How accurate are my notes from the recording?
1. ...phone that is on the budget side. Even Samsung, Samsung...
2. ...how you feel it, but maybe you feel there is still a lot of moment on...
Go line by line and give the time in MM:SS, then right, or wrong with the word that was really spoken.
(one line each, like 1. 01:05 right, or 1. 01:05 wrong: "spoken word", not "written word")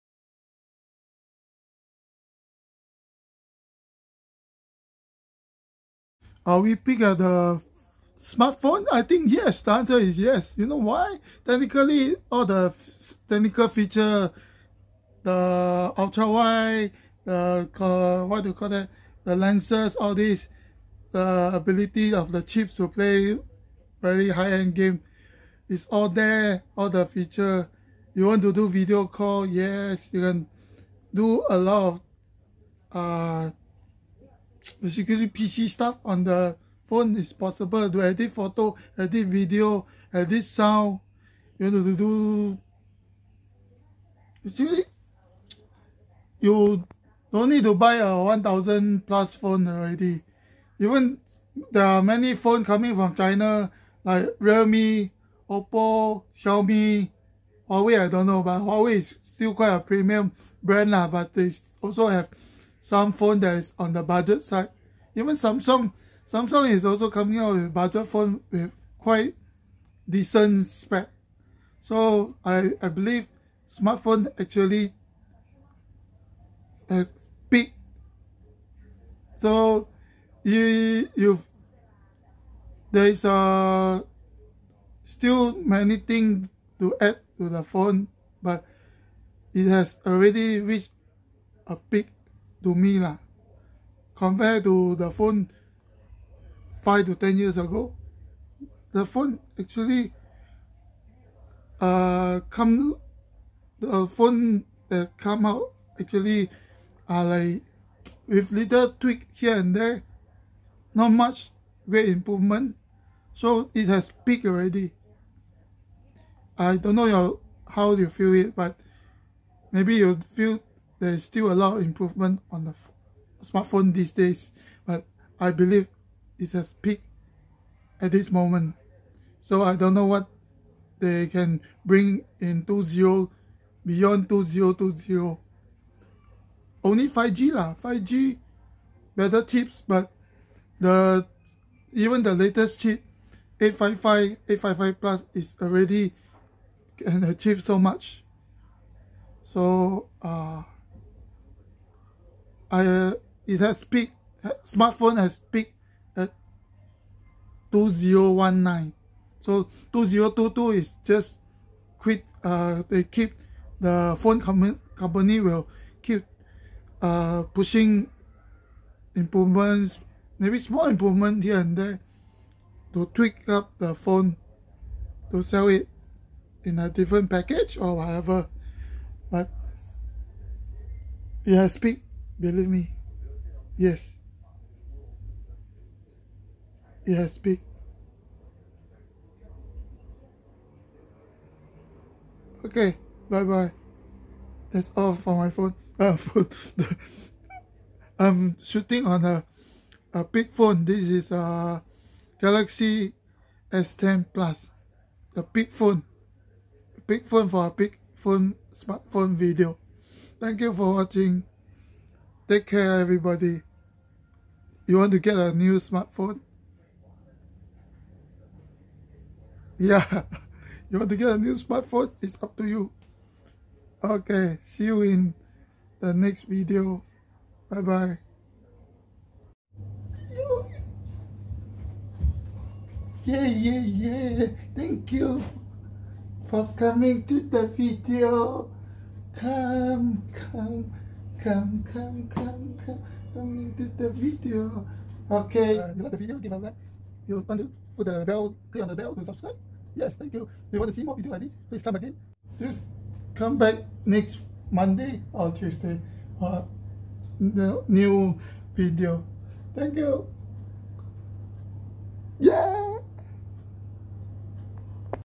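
1. 01:03 right
2. 01:57 wrong: "improvement", not "moment".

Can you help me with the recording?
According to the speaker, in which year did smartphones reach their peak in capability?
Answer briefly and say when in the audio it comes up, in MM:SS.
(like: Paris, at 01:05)
2019, at 02:37.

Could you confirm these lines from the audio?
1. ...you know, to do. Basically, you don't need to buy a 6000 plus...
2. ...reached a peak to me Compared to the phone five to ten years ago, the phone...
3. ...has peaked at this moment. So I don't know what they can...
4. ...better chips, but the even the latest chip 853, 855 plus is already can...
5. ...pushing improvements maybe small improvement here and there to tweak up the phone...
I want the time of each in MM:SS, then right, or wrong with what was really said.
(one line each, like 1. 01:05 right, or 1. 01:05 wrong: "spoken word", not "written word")
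1. 00:41 wrong: "1000", not "6000"
2. 01:30 right
3. 02:06 right
4. 02:19 wrong: "855", not "853"
5. 02:47 right.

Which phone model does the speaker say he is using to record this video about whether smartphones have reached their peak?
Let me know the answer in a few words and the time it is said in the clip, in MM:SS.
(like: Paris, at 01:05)
Galaxy S10 Plus, at 03:22.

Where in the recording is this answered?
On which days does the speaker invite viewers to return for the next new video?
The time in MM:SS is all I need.
04:14.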